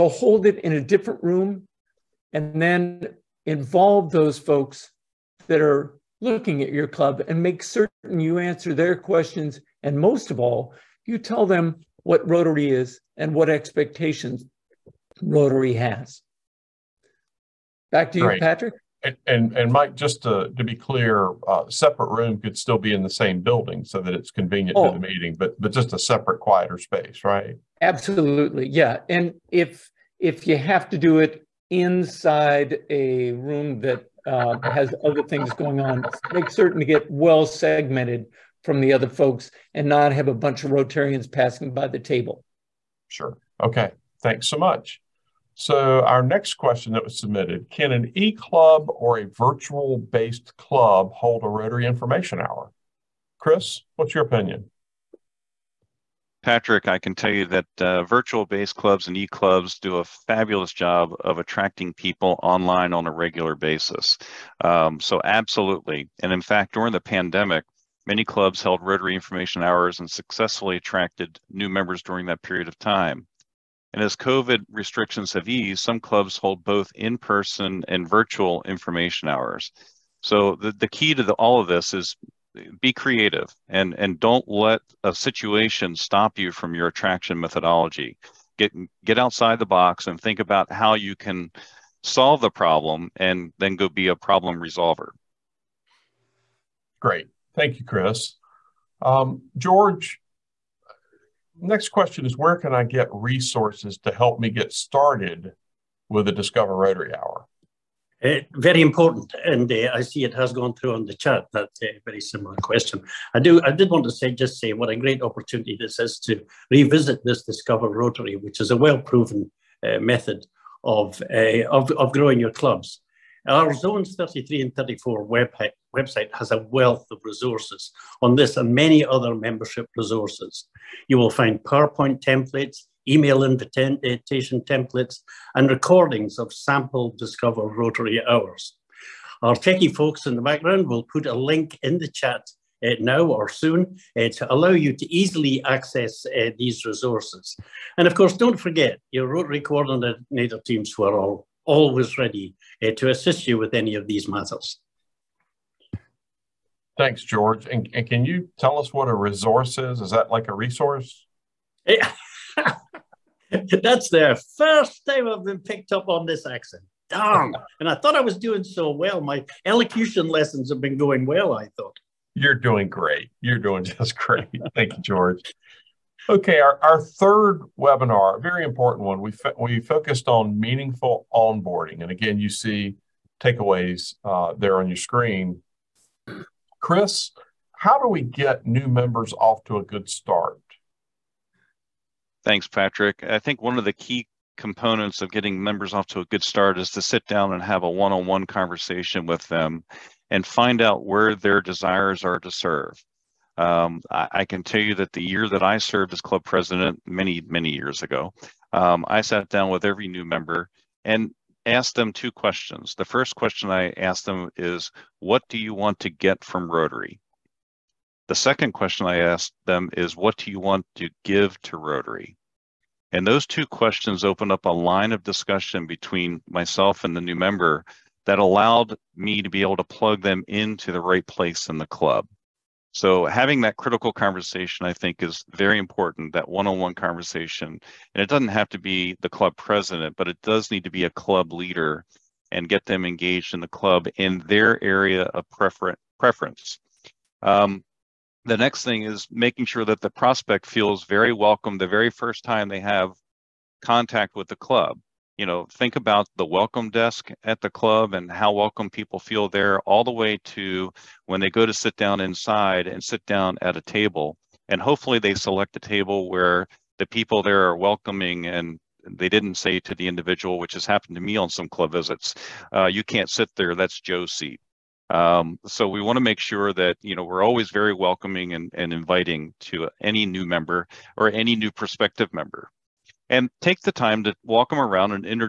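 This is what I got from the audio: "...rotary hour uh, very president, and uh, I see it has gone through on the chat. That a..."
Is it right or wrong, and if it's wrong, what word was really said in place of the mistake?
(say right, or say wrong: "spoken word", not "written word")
wrong: "important", not "president".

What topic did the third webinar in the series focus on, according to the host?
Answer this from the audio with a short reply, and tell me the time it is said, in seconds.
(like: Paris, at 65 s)
Meaningful onboarding, at 180 s.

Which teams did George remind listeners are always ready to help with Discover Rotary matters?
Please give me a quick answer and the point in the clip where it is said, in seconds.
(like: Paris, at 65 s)
Rotary Coordinator teams, at 149 s.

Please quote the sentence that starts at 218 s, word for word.
The second question I asked them is, what do you want to give to Rotary?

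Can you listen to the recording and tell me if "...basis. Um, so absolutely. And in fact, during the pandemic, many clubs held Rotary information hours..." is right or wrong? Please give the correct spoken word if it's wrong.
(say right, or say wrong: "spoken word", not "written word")
right.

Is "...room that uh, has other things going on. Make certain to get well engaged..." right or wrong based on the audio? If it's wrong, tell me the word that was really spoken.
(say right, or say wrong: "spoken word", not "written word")
wrong: "segmented", not "engaged".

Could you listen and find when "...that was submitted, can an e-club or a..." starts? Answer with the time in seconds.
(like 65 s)
46 s.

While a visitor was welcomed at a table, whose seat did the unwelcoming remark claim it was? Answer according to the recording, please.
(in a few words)
Joe.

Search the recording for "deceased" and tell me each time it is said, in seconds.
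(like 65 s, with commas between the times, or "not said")
not said.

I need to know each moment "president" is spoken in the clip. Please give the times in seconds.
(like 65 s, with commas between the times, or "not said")
206 s, 239 s.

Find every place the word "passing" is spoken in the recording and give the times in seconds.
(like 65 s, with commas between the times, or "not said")
41 s.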